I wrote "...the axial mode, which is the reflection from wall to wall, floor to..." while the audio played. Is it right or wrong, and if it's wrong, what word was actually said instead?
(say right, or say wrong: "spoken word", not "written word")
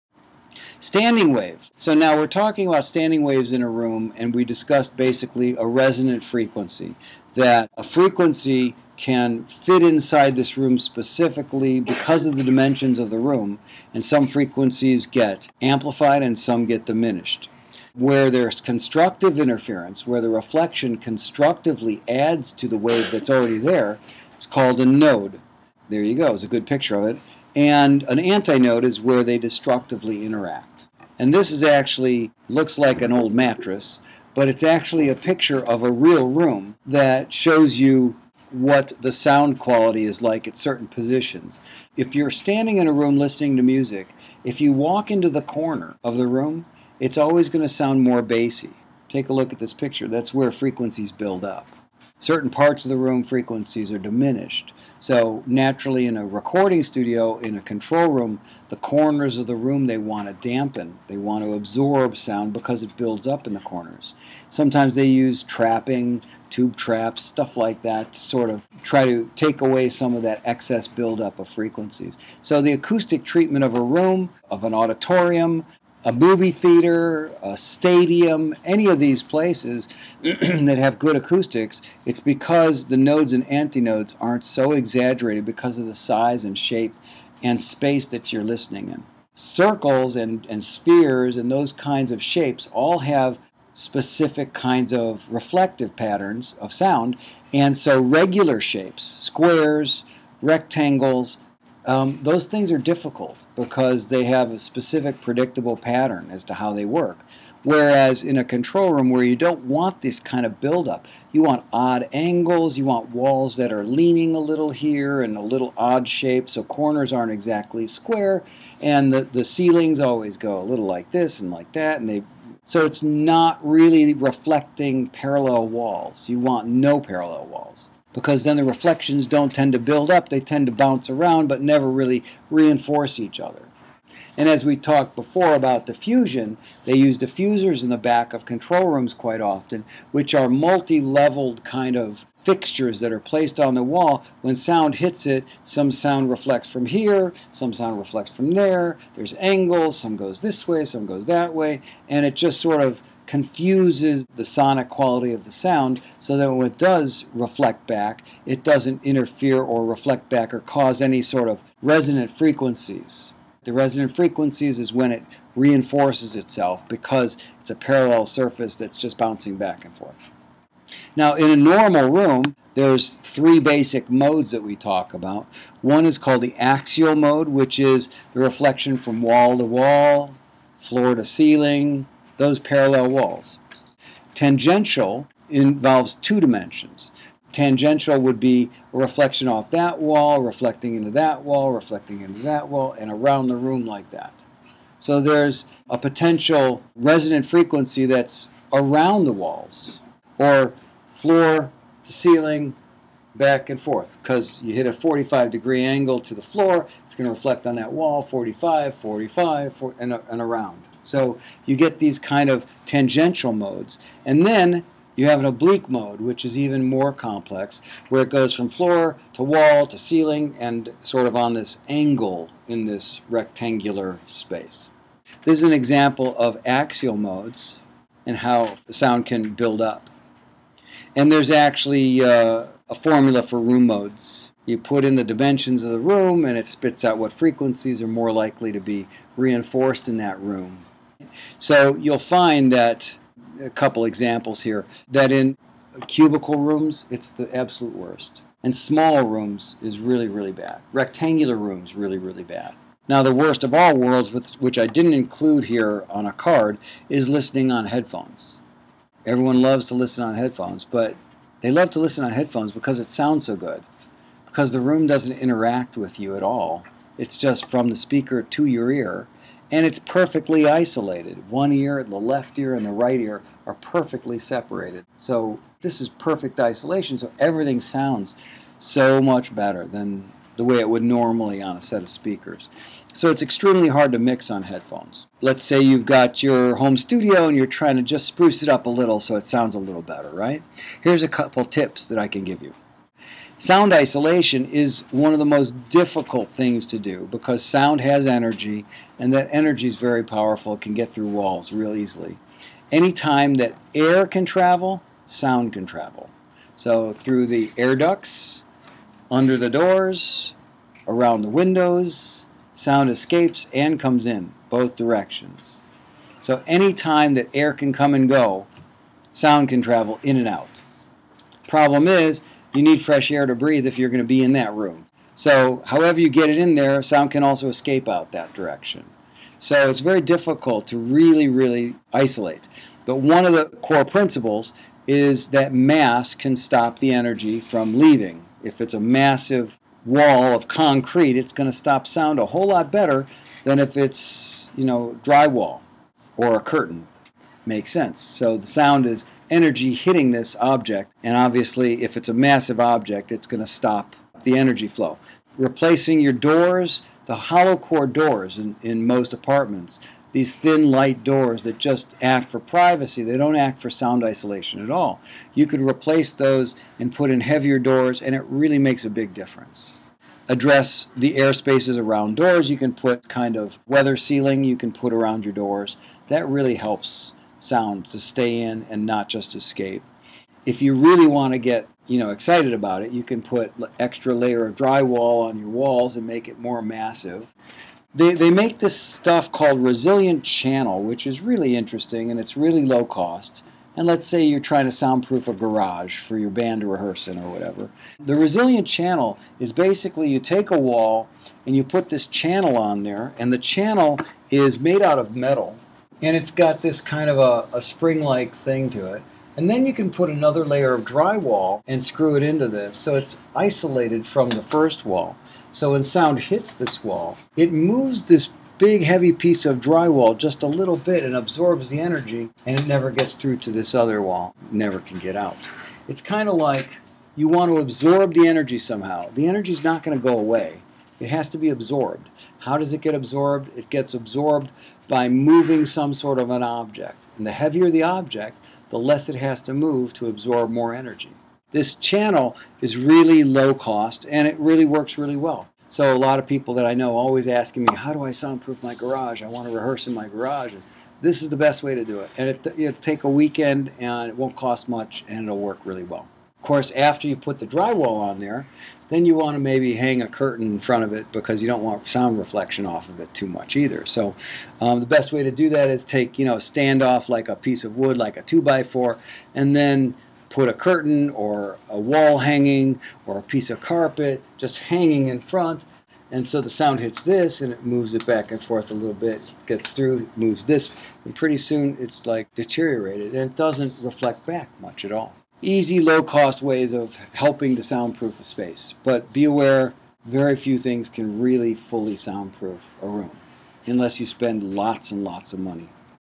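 right.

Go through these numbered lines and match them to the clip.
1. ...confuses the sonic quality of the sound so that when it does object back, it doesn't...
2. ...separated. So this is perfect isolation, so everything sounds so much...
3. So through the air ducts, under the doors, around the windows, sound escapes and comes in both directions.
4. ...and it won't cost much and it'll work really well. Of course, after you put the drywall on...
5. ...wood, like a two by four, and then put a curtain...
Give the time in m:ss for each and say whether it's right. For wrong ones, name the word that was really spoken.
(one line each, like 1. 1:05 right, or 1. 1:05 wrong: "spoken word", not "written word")
1. 2:33 wrong: "reflect", not "object"
2. 4:34 right
3. 5:06 right
4. 7:33 right
5. 7:47 right.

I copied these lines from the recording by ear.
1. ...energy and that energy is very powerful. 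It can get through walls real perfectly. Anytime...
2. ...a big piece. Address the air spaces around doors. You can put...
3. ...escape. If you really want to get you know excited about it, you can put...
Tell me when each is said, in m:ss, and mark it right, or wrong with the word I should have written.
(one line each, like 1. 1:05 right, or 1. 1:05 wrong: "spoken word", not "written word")
1. 4:58 wrong: "easily", not "perfectly"
2. 6:09 wrong: "difference", not "piece"
3. 6:19 right.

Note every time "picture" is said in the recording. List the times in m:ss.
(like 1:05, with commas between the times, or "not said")
0:26, 0:35, 0:49.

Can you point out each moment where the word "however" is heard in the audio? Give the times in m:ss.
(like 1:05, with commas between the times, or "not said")
5:25.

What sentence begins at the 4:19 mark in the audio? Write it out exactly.
Everyone loves to listen on headphones, but they love to listen on headphones because it sounds so good.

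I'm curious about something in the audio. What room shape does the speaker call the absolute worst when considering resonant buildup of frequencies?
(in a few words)
cubical rooms.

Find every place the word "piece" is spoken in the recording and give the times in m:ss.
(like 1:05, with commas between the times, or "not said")
6:59, 7:47, 7:53.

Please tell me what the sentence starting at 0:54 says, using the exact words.
So naturally in a recording studio, in a control room, the corners of the room they want to dampen.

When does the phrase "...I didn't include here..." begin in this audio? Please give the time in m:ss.
4:14.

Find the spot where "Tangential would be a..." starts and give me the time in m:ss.
3:07.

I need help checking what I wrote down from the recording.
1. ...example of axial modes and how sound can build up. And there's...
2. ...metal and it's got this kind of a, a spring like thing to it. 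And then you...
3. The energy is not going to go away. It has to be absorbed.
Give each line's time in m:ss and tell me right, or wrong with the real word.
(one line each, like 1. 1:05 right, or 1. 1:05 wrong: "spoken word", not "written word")
1. 3:45 right
2. 6:45 right
3. 7:09 right.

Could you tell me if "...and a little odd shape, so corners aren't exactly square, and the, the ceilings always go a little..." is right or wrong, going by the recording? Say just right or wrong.
right.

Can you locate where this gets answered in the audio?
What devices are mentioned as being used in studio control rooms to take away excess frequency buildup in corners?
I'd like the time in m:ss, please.
1:06.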